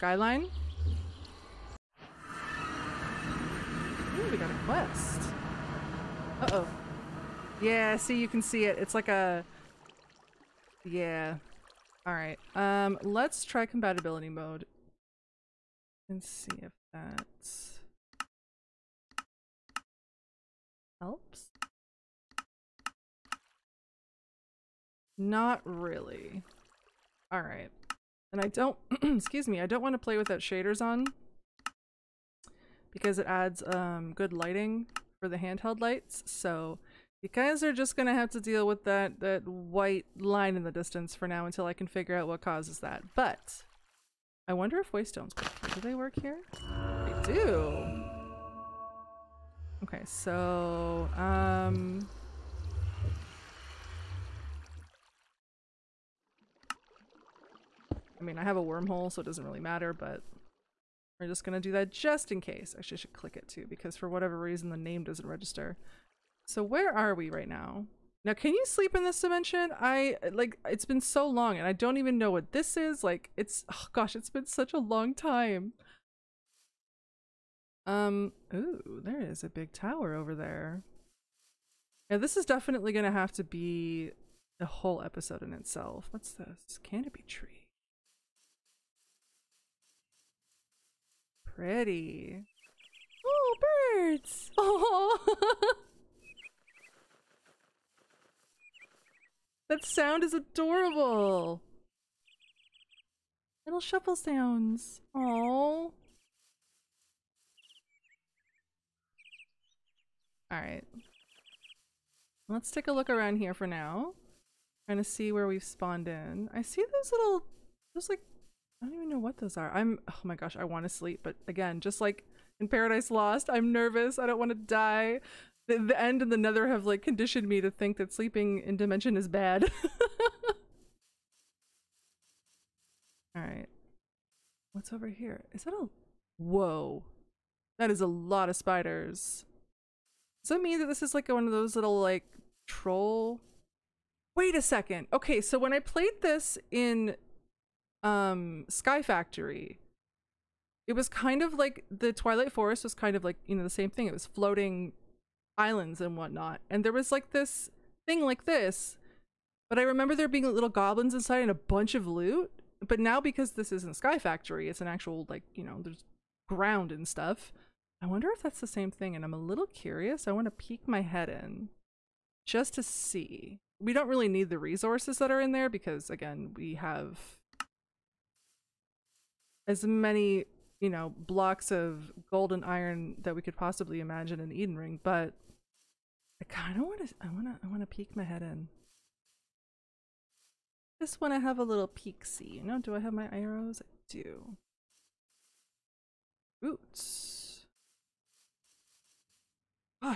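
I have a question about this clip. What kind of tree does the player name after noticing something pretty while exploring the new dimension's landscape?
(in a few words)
Canopy tree.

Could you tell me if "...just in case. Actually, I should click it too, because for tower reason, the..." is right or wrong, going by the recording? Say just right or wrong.
wrong.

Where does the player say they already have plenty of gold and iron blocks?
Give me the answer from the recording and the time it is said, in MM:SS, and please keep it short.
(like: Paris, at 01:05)
Eden Ring, at 03:04.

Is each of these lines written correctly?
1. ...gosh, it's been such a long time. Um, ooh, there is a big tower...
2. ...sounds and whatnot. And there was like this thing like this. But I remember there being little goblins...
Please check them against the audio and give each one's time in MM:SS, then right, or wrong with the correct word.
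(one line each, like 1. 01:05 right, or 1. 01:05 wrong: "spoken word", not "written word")
1. 01:13 right
2. 02:35 wrong: "islands", not "sounds".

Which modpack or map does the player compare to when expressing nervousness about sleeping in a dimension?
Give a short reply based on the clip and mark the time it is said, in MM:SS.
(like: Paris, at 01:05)
Paradise Lost, at 02:02.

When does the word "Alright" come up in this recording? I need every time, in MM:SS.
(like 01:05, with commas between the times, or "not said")
00:12, 00:27.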